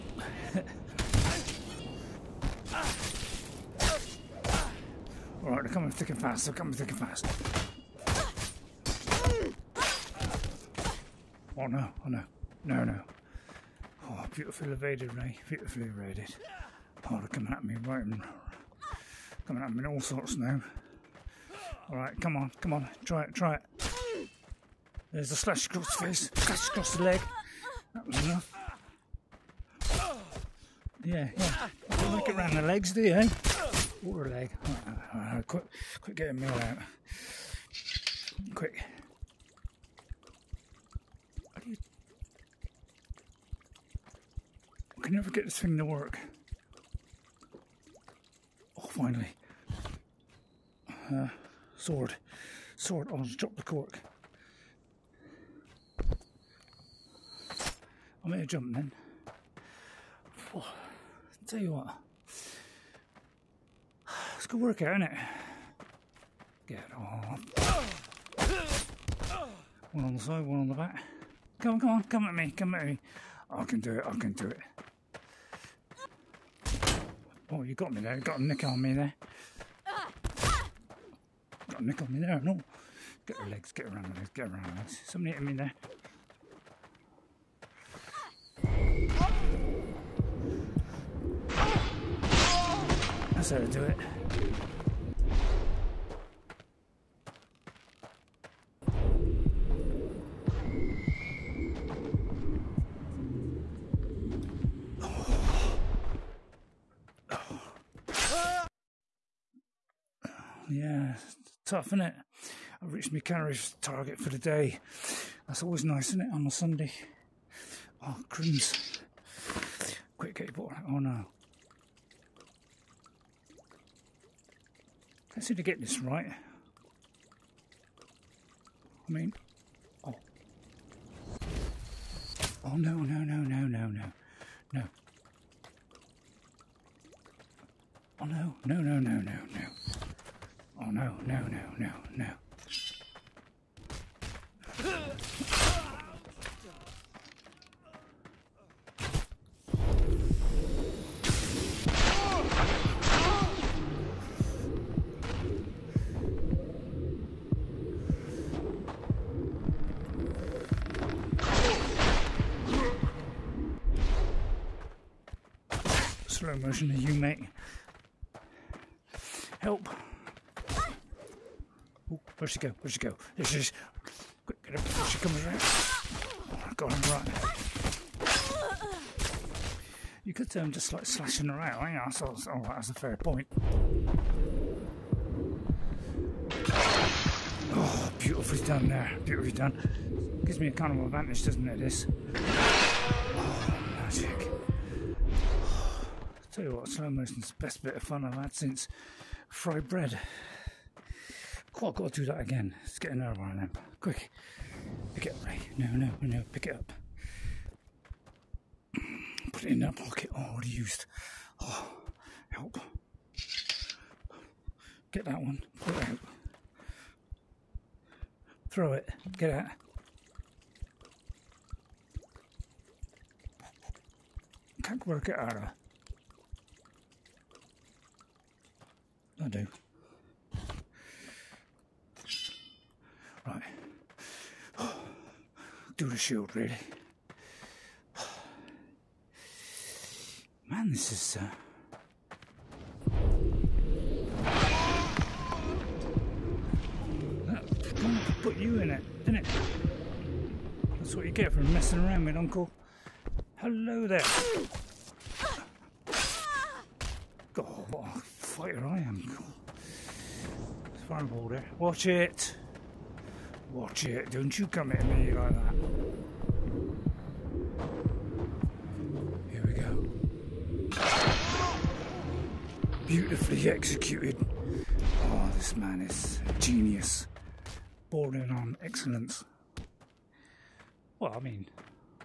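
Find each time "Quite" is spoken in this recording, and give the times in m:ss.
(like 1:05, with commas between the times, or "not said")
3:21.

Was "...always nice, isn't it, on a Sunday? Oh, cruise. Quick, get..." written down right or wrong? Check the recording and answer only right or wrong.
right.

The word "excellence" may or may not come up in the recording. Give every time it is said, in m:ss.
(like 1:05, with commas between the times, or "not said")
4:38.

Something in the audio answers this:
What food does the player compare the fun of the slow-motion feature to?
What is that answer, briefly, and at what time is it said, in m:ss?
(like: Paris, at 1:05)
fried bread, at 3:19.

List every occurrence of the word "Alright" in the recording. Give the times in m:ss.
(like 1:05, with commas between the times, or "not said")
0:05, 0:21.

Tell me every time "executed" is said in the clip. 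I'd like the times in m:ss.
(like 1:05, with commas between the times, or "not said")
4:33.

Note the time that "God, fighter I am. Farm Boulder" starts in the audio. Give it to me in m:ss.
4:17.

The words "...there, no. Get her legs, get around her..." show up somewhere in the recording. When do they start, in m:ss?
1:22.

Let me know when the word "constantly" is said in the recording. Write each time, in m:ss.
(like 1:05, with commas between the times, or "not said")
not said.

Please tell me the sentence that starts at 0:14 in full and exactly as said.
Oh, beautifully evaded, Ray, beautifully evaded.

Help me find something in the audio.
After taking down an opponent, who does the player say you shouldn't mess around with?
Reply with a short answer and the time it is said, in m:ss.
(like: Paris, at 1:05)
Uncle, at 4:12.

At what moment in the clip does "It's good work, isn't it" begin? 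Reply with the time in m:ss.
1:04.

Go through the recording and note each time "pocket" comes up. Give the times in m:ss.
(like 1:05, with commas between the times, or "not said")
3:29.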